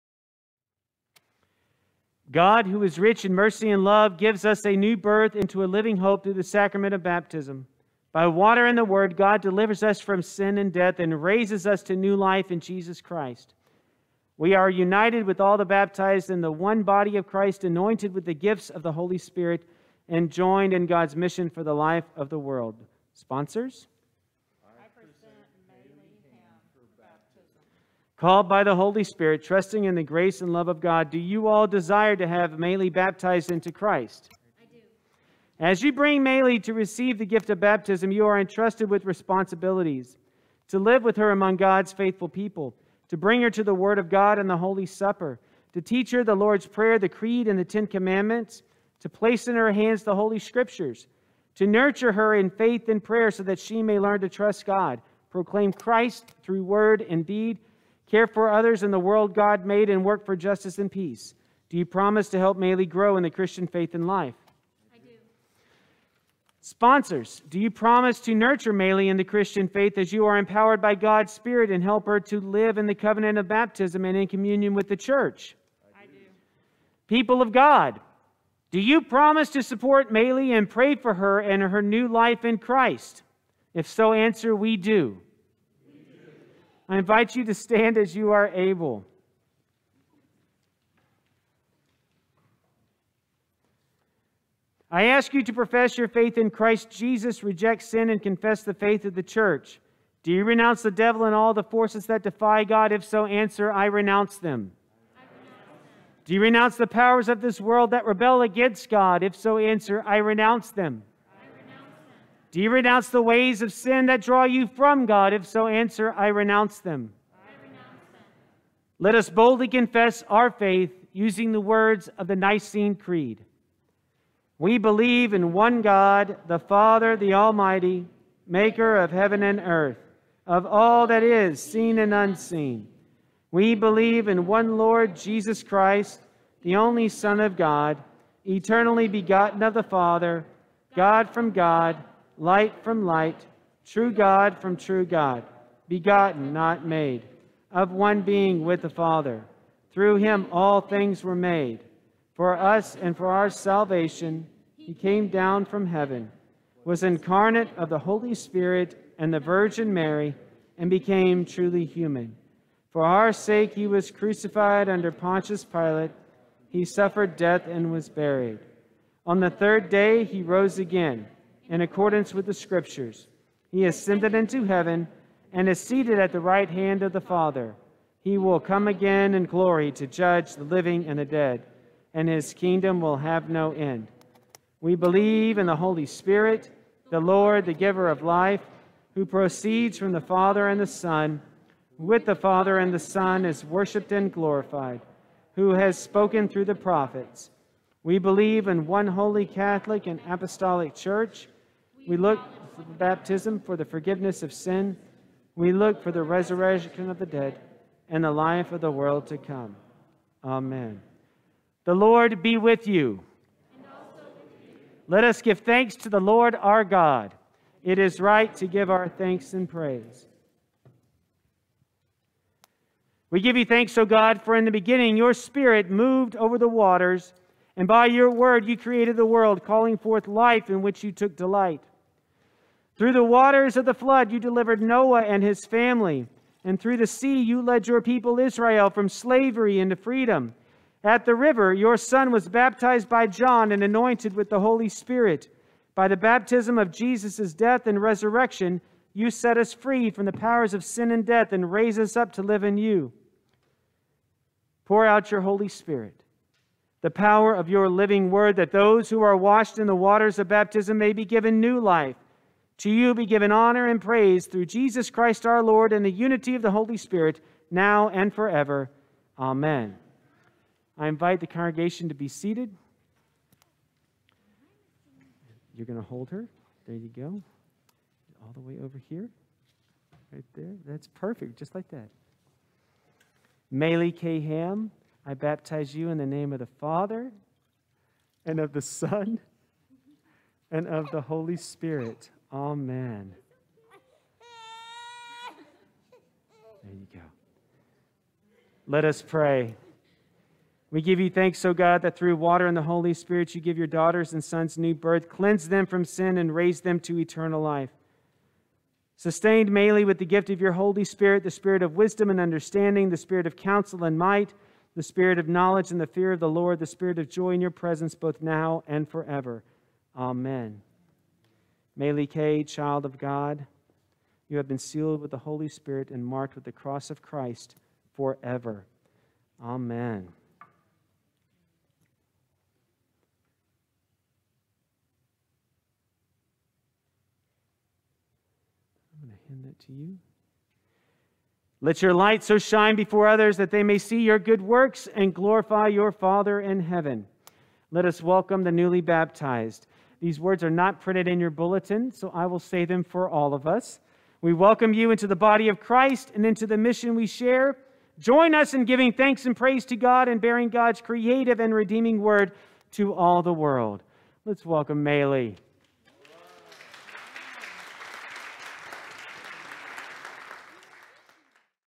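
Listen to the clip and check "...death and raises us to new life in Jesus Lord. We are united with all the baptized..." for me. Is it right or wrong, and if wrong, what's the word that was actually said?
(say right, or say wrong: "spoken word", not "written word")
wrong: "Christ", not "Lord".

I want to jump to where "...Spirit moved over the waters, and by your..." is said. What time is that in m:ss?
3:45.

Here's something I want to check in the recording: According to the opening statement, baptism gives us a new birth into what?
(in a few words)
a living hope.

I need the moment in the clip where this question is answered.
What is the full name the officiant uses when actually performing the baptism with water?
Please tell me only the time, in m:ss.
4:43.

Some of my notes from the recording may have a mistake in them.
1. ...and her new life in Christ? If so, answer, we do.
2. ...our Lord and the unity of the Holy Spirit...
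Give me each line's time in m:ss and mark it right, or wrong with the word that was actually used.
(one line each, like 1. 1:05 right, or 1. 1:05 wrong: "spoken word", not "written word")
1. 1:21 right
2. 4:25 right.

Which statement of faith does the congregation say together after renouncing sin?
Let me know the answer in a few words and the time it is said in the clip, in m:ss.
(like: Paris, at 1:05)
Nicene Creed, at 2:02.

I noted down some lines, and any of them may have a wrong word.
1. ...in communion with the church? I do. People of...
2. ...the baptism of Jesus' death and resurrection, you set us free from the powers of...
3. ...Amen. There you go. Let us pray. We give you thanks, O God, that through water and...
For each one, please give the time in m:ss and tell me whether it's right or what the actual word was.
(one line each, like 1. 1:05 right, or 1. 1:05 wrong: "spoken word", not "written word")
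1. 1:14 right
2. 4:06 right
3. 4:52 right.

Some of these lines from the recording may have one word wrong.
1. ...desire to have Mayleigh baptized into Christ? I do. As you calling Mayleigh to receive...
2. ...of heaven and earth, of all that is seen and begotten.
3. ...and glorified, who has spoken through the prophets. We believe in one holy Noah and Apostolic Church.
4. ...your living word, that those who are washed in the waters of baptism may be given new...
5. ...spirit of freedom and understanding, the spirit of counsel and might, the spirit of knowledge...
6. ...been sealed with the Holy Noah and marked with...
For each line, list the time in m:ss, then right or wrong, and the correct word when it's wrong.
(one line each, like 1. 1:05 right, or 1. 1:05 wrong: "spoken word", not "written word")
1. 0:31 wrong: "bring", not "calling"
2. 2:08 wrong: "unseen", not "begotten"
3. 3:14 wrong: "Catholic", not "Noah"
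4. 4:17 right
5. 5:11 wrong: "wisdom", not "freedom"
6. 5:24 wrong: "Spirit", not "Noah".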